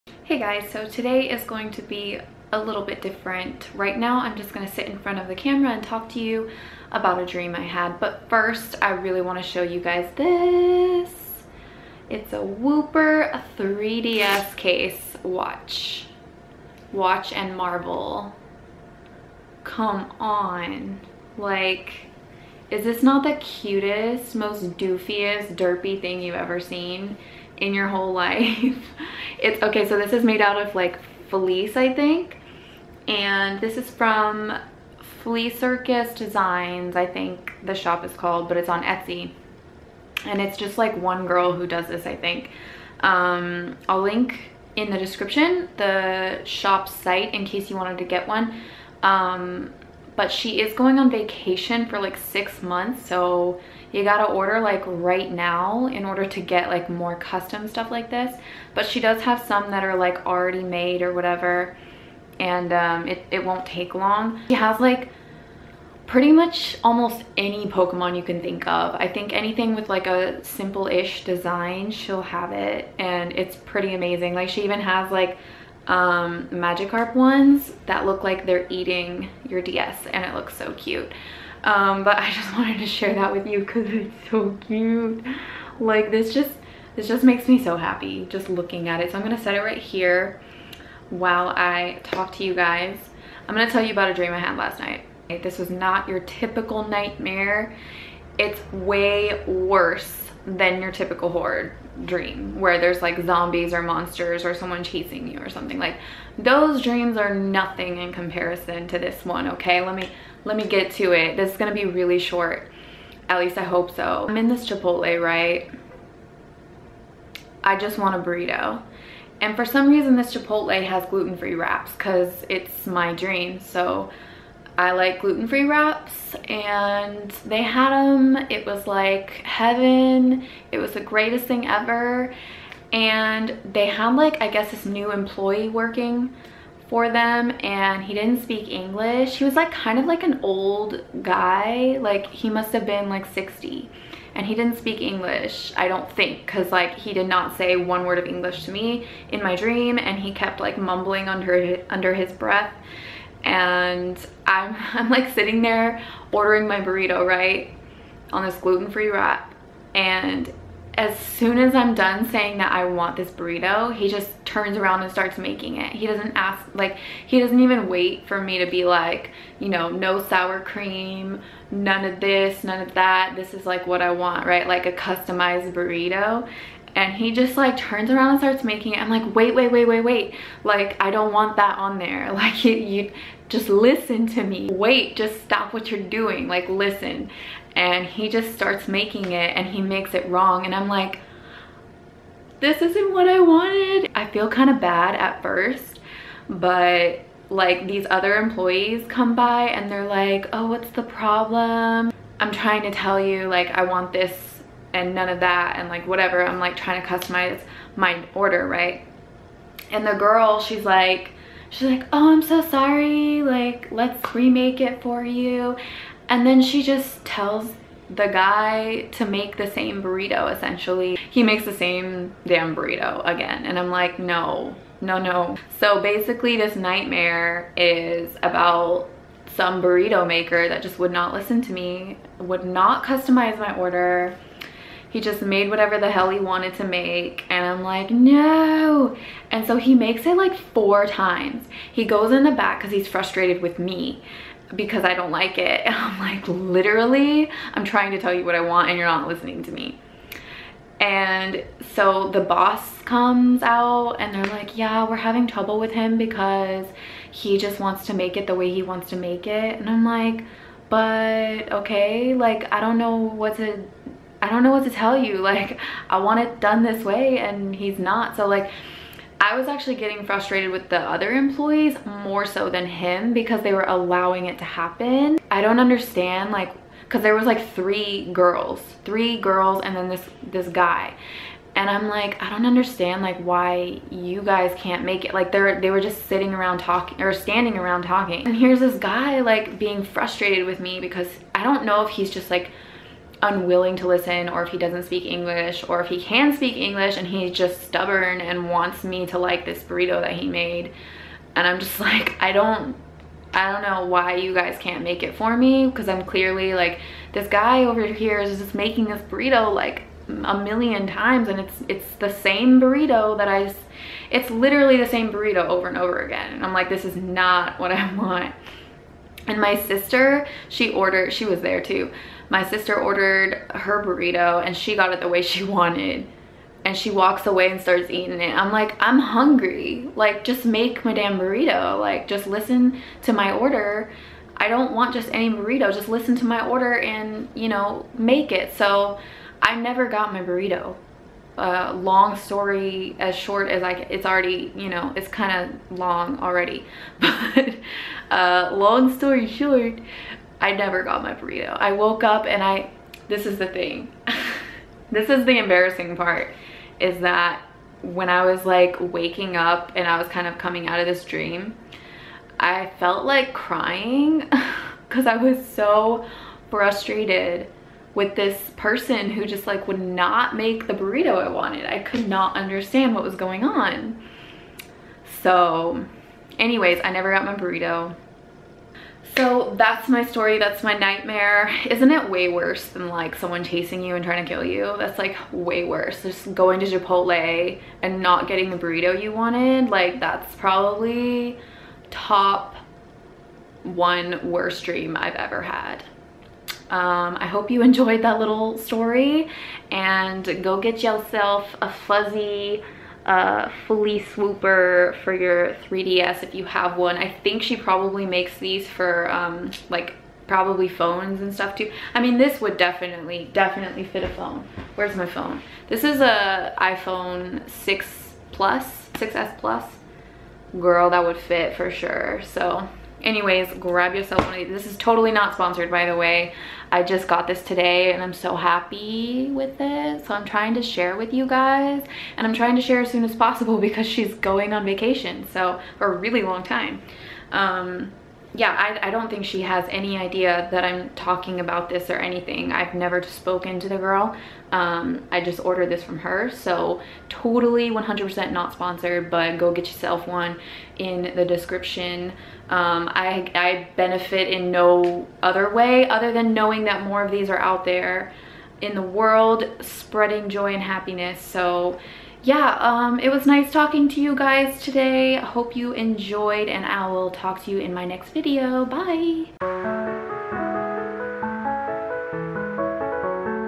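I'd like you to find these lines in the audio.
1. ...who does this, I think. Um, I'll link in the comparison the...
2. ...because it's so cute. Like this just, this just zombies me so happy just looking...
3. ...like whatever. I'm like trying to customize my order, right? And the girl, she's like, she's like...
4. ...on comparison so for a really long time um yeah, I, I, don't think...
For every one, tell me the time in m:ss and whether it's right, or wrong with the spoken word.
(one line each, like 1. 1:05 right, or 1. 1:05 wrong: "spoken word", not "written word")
1. 0:41 wrong: "description", not "comparison"
2. 1:23 wrong: "makes", not "zombies"
3. 3:25 right
4. 7:14 wrong: "vacation", not "comparison".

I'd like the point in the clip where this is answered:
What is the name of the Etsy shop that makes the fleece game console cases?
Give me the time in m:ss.
0:35.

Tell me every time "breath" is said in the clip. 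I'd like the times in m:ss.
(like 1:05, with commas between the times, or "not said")
2:32.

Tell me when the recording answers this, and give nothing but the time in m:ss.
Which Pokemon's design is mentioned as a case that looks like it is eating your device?
1:16.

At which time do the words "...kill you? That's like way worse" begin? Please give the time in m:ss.
6:24.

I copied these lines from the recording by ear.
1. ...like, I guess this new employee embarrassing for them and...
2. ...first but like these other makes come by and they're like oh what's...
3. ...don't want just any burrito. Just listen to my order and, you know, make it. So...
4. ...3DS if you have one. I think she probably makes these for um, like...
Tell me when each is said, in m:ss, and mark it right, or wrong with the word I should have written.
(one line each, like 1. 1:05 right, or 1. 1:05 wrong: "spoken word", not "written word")
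1. 2:14 wrong: "working", not "embarrassing"
2. 3:15 wrong: "employees", not "makes"
3. 5:34 right
4. 6:45 right.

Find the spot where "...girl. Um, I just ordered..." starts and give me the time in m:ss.
7:23.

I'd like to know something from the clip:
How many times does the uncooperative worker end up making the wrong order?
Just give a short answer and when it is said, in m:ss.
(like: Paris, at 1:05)
4, at 4:00.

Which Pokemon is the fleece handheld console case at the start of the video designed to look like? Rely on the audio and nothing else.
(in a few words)
Wooper.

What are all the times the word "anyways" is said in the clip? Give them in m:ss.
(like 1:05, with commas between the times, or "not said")
6:16, 7:03.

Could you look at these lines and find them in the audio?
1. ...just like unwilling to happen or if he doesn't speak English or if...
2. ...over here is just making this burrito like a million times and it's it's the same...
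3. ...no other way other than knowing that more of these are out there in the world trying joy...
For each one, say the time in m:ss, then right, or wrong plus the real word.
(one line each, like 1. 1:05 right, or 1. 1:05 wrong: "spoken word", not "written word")
1. 4:52 wrong: "listen", not "happen"
2. 5:07 right
3. 7:34 wrong: "spreading", not "trying".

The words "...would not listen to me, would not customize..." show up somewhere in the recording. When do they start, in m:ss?
3:50.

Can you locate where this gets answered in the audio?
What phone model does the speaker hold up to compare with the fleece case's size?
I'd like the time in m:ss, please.
6:59.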